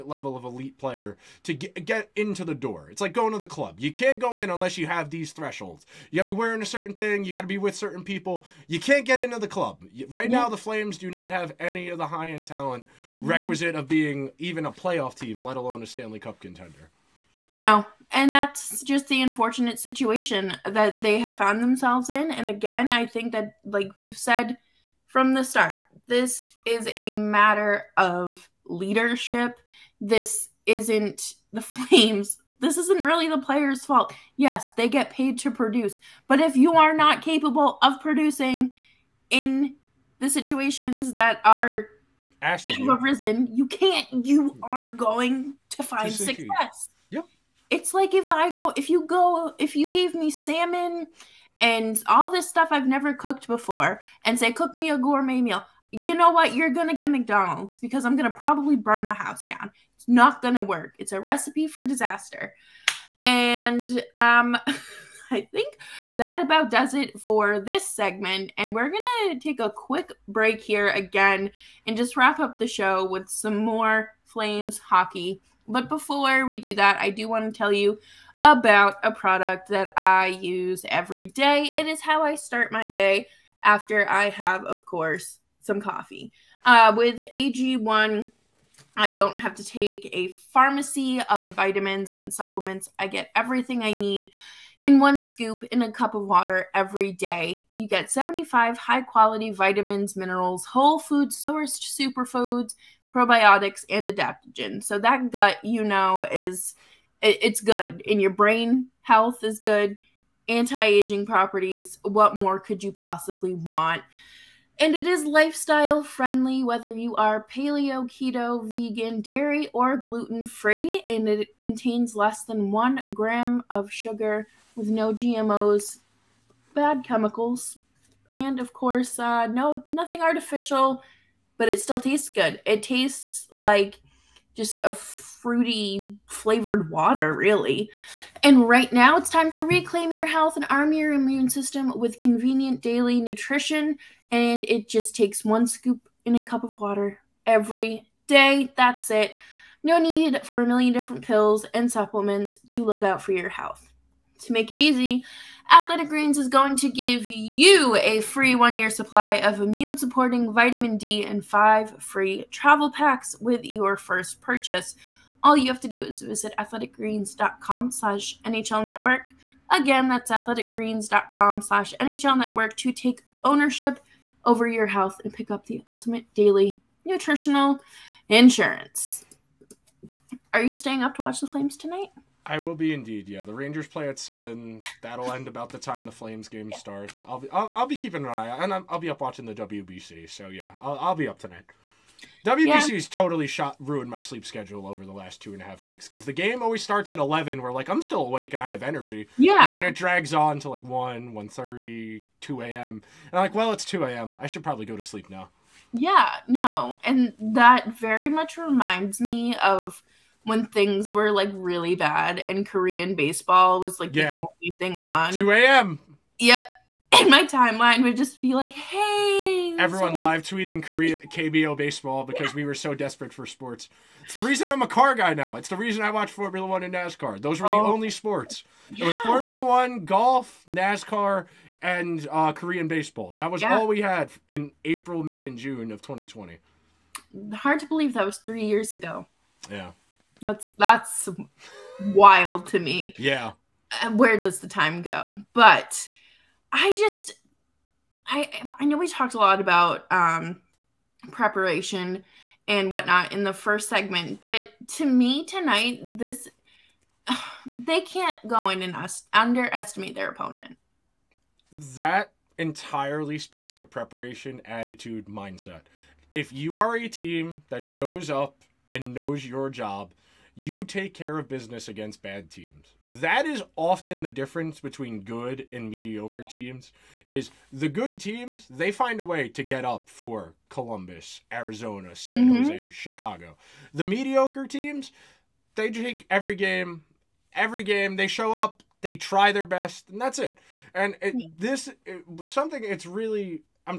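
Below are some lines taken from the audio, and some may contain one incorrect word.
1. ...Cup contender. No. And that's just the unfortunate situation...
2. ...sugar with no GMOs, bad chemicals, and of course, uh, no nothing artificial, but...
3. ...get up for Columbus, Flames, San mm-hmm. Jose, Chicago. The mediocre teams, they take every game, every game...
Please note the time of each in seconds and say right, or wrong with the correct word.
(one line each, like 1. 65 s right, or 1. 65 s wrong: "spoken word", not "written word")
1. 16 s right
2. 123 s right
3. 279 s wrong: "Arizona", not "Flames".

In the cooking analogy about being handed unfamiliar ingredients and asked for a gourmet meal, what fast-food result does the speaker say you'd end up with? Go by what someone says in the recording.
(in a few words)
McDonald's.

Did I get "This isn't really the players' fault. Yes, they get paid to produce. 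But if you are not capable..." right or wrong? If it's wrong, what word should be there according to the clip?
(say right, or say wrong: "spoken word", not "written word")
right.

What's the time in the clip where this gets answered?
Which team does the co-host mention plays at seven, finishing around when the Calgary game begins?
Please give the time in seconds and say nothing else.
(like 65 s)
183 s.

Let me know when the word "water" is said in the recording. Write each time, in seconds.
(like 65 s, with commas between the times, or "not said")
96 s, 136 s, 146 s.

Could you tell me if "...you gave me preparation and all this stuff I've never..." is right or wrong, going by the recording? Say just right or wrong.
wrong.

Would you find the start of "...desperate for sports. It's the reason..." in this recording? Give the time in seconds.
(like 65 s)
222 s.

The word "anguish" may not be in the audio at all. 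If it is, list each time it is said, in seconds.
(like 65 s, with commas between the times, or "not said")
not said.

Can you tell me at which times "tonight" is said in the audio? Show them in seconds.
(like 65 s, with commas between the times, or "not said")
181 s, 191 s, 255 s.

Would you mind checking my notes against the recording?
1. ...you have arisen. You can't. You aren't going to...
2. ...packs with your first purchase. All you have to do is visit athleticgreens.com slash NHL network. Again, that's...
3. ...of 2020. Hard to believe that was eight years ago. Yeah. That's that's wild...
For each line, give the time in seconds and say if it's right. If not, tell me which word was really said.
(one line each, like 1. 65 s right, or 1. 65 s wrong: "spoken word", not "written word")
1. 42 s right
2. 162 s right
3. 235 s wrong: "three", not "eight".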